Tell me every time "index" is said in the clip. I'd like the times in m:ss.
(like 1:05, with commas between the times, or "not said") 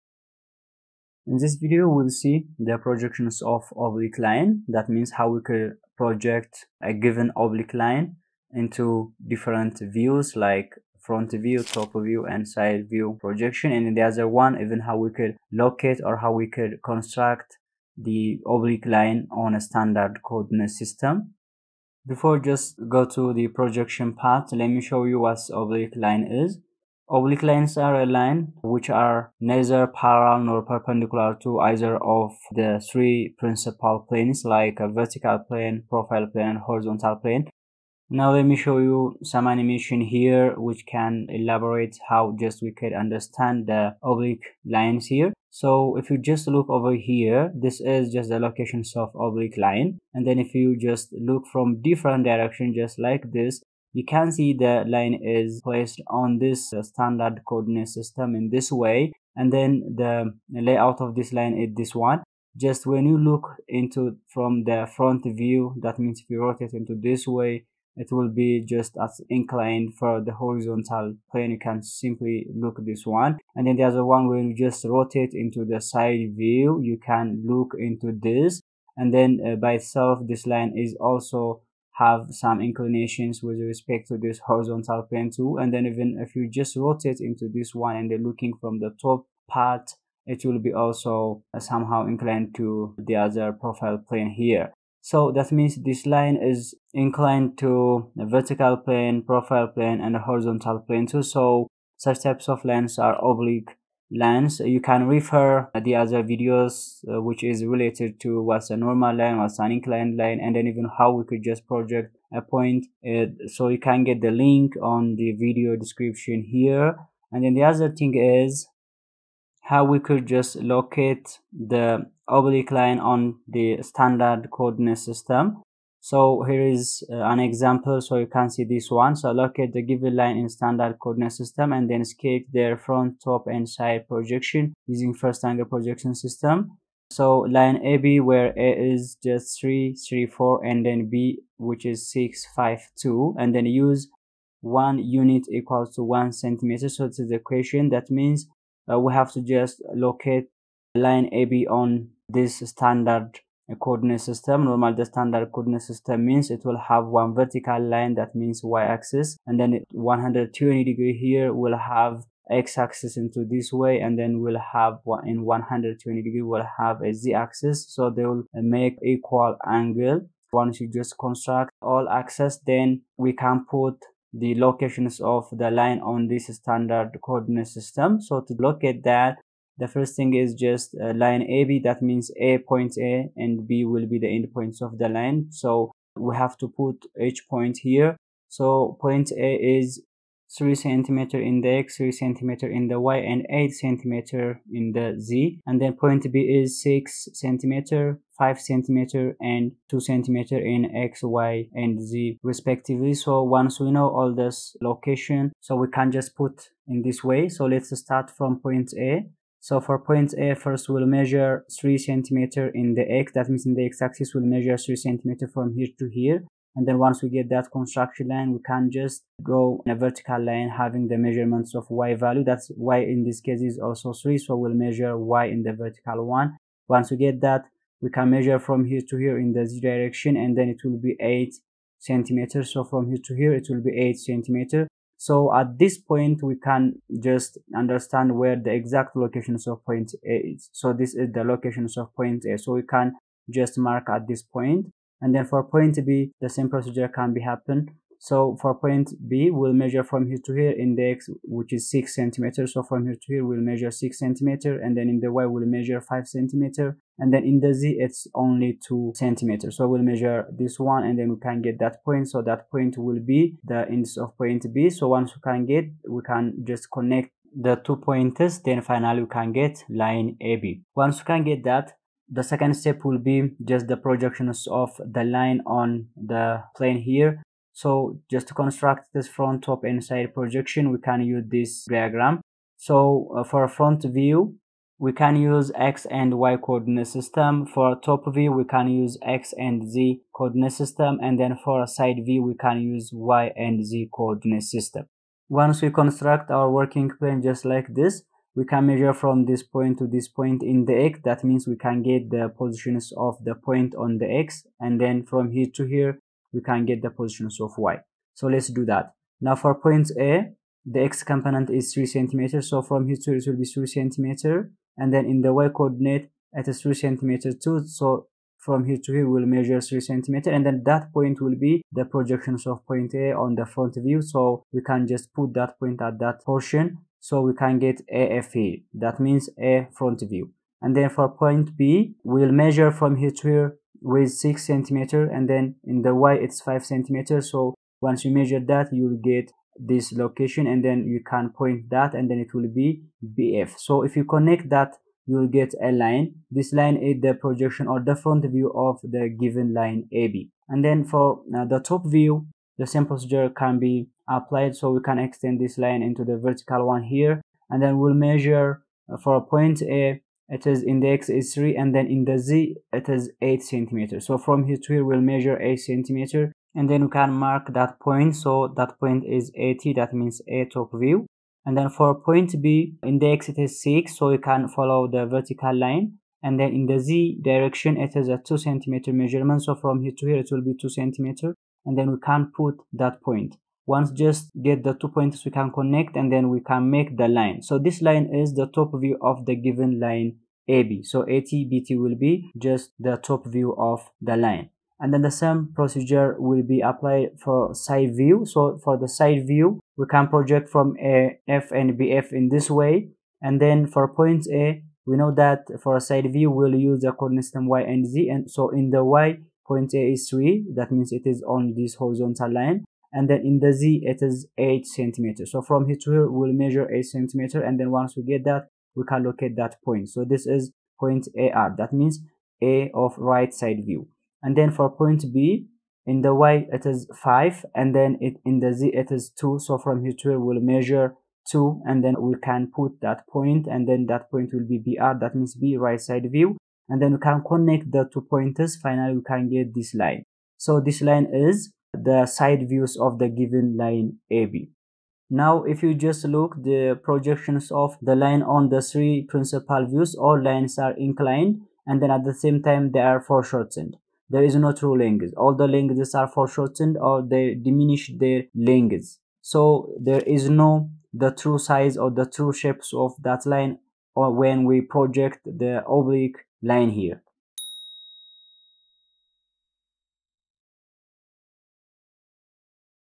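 4:10, 4:23.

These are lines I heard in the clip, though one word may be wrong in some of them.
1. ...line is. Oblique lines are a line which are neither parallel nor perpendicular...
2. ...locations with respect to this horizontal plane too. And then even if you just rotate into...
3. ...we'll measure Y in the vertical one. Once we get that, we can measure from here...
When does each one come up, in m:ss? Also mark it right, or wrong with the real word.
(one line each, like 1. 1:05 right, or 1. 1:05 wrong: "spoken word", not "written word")
1. 0:25 right
2. 1:22 wrong: "inclinations", not "locations"
3. 3:44 right.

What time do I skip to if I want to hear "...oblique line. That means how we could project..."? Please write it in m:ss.
0:03.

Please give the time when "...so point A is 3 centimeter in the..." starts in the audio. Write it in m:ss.
3:08.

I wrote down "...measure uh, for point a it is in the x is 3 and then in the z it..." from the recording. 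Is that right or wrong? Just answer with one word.
right.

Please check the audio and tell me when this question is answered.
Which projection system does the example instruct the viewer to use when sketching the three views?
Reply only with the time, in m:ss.
2:15.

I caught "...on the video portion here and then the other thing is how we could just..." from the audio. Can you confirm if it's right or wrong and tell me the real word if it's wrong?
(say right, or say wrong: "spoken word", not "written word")
wrong: "description", not "portion".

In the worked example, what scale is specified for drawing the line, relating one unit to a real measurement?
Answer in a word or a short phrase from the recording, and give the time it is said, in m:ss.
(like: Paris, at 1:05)
1 centimeter, at 2:24.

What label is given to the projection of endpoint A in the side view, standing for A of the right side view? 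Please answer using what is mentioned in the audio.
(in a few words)
AR.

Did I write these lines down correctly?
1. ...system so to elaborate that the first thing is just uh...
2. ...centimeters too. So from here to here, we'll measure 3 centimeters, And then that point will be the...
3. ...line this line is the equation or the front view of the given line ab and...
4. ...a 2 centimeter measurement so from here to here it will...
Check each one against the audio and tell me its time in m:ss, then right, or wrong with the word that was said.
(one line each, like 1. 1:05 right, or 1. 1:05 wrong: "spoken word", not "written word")
1. 2:57 wrong: "locate", not "elaborate"
2. 5:16 right
3. 5:45 wrong: "projection", not "equation"
4. 6:18 right.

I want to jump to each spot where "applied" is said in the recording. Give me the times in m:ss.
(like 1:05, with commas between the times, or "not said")
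5:54, 6:36.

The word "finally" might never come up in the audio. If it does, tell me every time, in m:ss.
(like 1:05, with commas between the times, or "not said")
4:28, 7:18.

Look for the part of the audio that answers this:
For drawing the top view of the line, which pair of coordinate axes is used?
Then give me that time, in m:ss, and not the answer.
4:49.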